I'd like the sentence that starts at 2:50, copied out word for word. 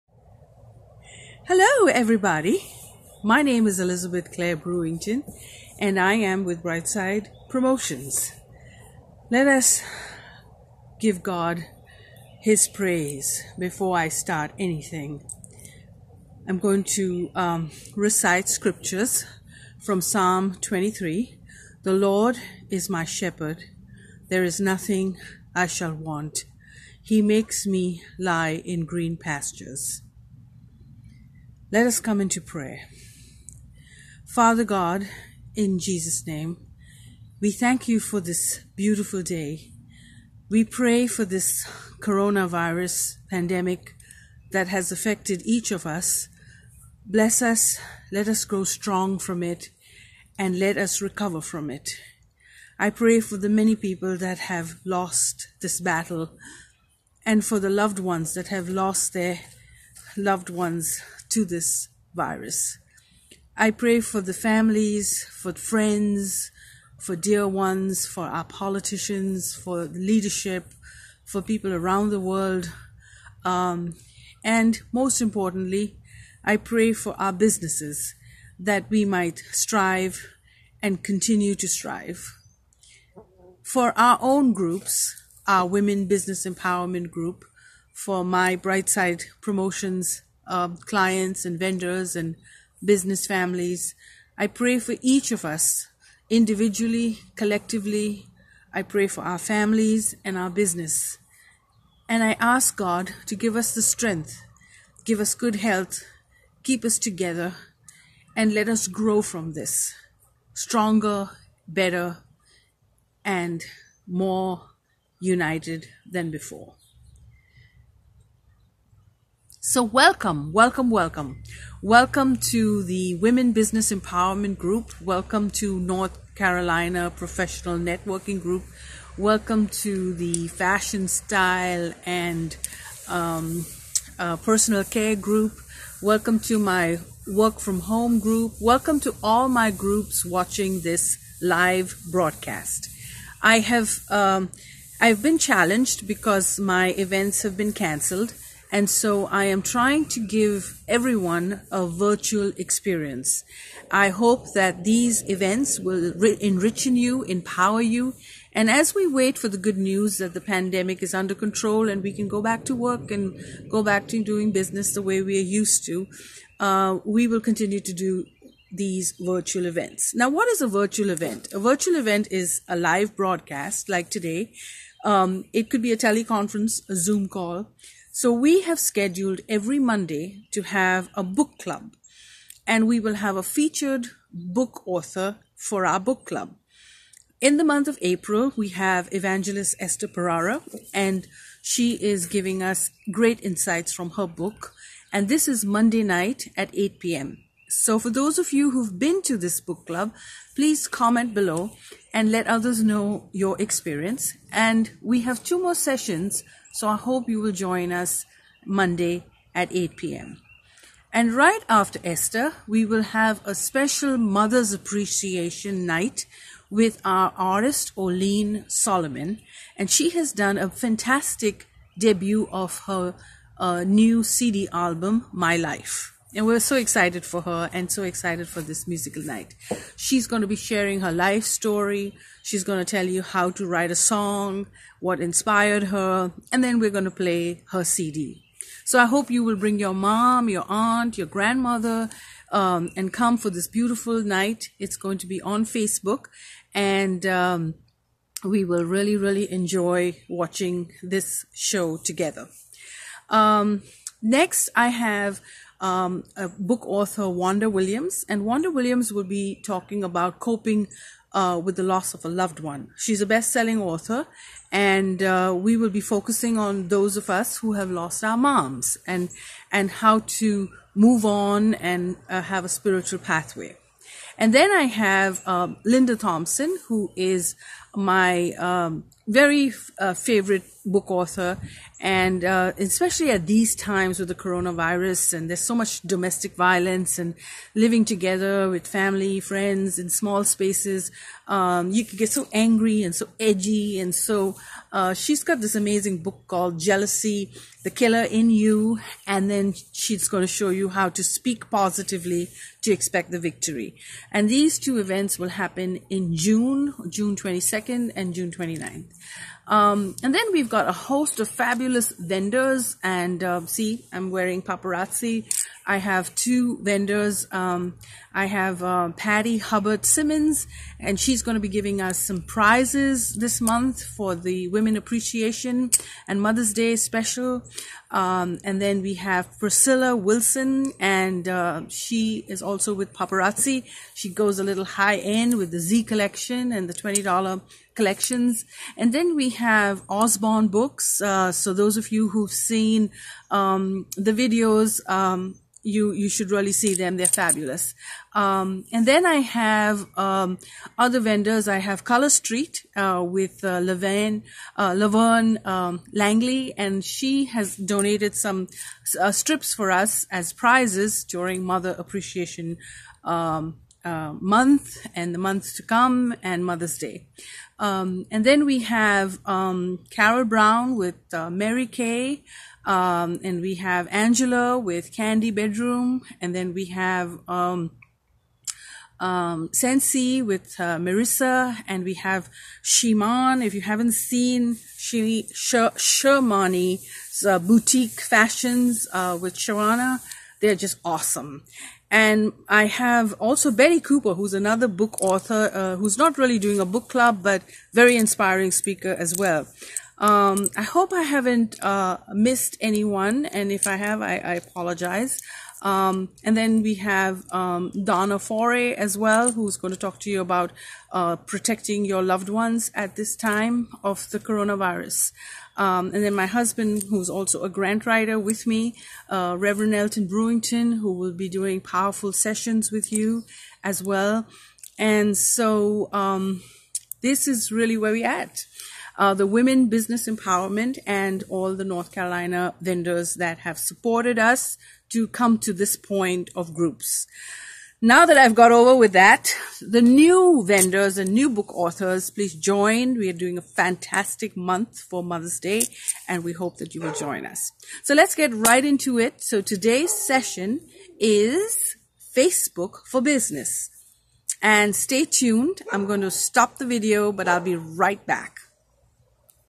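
Now, what is a virtual event?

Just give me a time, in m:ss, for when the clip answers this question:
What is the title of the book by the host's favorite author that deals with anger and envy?
4:56.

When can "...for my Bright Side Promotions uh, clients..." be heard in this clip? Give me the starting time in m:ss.
1:27.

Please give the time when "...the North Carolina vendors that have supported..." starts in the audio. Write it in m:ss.
7:11.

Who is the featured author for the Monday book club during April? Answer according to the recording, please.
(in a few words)
Esther Perara.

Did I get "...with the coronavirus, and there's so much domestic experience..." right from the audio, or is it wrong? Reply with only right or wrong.
wrong.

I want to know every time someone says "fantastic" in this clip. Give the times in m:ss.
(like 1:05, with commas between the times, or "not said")
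3:40, 7:23.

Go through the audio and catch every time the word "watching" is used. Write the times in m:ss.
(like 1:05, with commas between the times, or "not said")
2:20, 4:10.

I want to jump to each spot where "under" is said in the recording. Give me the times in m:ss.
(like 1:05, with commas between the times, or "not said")
2:41.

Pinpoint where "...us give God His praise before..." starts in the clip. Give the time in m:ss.
0:09.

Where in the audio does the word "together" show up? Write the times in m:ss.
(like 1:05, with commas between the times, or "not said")
1:46, 4:11, 4:48.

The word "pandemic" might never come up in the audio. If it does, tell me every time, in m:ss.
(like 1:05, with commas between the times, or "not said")
0:43, 2:40.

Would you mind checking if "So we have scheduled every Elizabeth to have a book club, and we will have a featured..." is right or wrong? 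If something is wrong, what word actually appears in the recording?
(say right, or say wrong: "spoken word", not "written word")
wrong: "Monday", not "Elizabeth".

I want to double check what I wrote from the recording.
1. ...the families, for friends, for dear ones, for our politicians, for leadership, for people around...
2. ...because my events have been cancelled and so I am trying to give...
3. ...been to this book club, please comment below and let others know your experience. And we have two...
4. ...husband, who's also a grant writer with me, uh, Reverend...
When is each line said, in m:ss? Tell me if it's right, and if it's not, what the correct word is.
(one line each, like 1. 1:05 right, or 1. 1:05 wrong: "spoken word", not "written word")
1. 1:04 right
2. 2:26 right
3. 3:18 right
4. 6:56 right.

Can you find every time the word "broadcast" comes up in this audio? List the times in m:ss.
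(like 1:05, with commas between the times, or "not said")
2:22, 2:53.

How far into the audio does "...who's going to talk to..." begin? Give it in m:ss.
6:49.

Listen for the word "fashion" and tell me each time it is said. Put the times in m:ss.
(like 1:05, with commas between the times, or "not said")
2:10, 6:28.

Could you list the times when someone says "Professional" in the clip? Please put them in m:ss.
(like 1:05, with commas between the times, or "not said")
2:07.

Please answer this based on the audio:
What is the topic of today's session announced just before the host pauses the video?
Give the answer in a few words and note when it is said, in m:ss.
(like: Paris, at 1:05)
Facebook for Business, at 7:32.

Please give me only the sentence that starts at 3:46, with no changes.
And we're so excited for her and so excited for this musical night.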